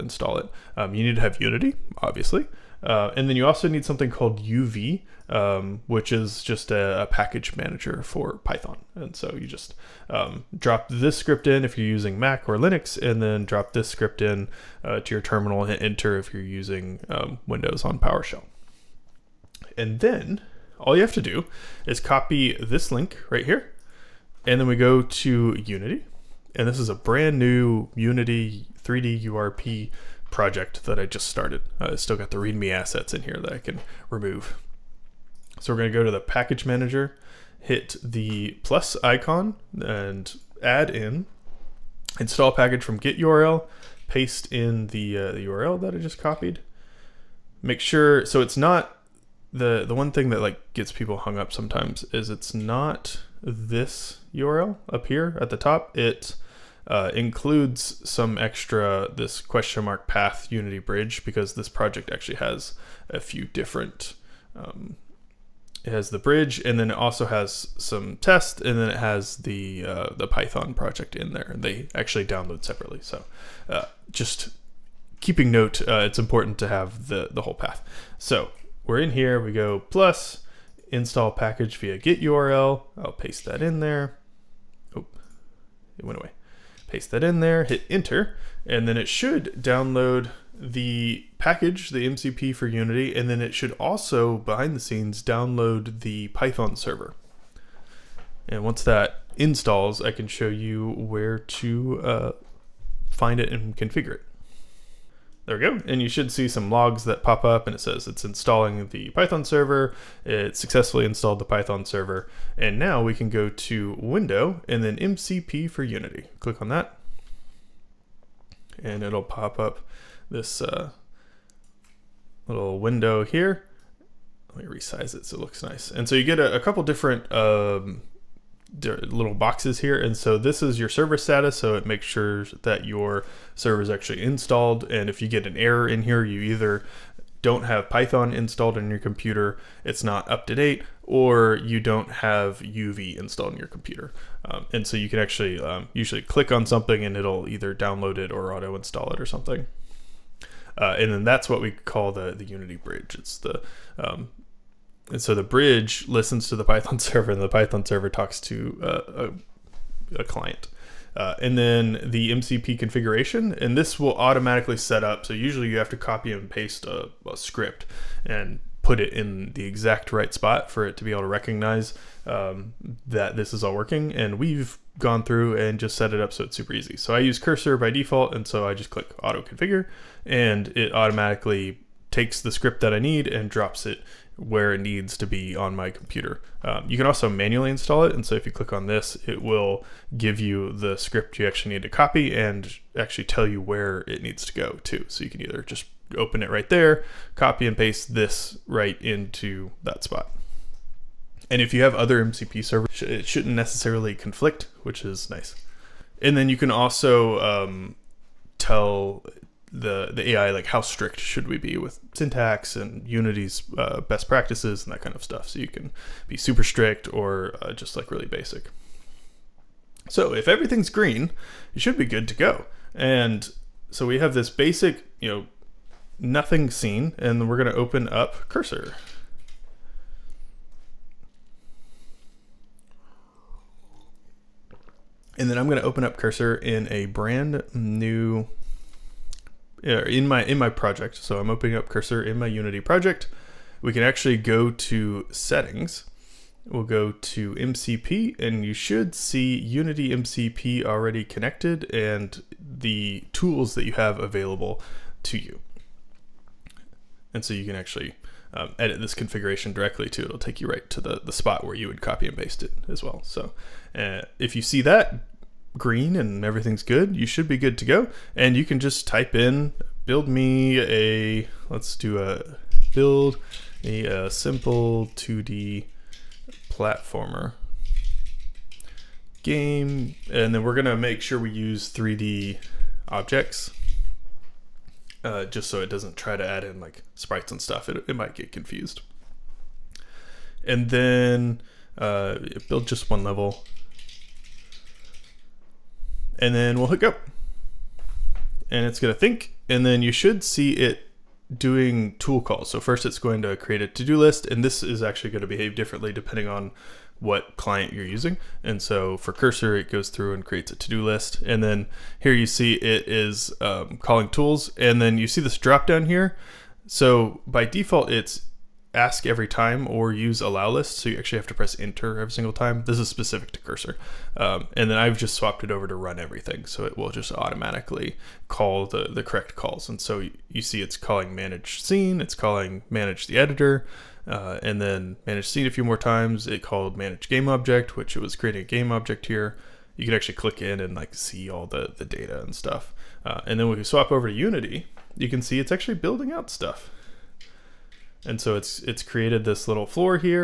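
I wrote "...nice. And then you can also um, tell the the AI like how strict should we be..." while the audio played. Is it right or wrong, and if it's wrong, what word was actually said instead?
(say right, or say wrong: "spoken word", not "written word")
right.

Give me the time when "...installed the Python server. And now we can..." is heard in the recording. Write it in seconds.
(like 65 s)
111 s.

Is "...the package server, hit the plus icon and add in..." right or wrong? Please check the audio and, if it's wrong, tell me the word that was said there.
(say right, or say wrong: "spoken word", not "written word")
wrong: "manager", not "server".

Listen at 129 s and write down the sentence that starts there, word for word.
And so this is your server status.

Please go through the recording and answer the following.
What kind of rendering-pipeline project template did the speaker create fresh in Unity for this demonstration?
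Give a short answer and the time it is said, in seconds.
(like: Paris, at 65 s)
3D URP, at 28 s.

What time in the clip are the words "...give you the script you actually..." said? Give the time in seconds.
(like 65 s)
190 s.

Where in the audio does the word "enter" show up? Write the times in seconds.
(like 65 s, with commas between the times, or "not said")
15 s, 87 s, 321 s.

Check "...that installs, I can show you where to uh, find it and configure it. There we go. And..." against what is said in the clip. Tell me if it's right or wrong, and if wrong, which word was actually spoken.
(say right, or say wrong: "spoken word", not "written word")
right.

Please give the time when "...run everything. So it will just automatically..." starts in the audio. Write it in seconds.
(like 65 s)
325 s.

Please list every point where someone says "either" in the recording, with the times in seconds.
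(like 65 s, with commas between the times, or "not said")
136 s, 147 s, 195 s.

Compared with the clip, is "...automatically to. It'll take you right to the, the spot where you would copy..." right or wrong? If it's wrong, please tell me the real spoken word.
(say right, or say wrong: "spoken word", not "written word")
wrong: "directly", not "automatically".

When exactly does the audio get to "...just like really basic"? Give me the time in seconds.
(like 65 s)
217 s.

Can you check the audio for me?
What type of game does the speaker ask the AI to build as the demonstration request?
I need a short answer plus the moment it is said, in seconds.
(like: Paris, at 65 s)
2D platformer, at 275 s.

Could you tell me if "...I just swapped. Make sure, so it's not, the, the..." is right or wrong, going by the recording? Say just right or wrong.
wrong.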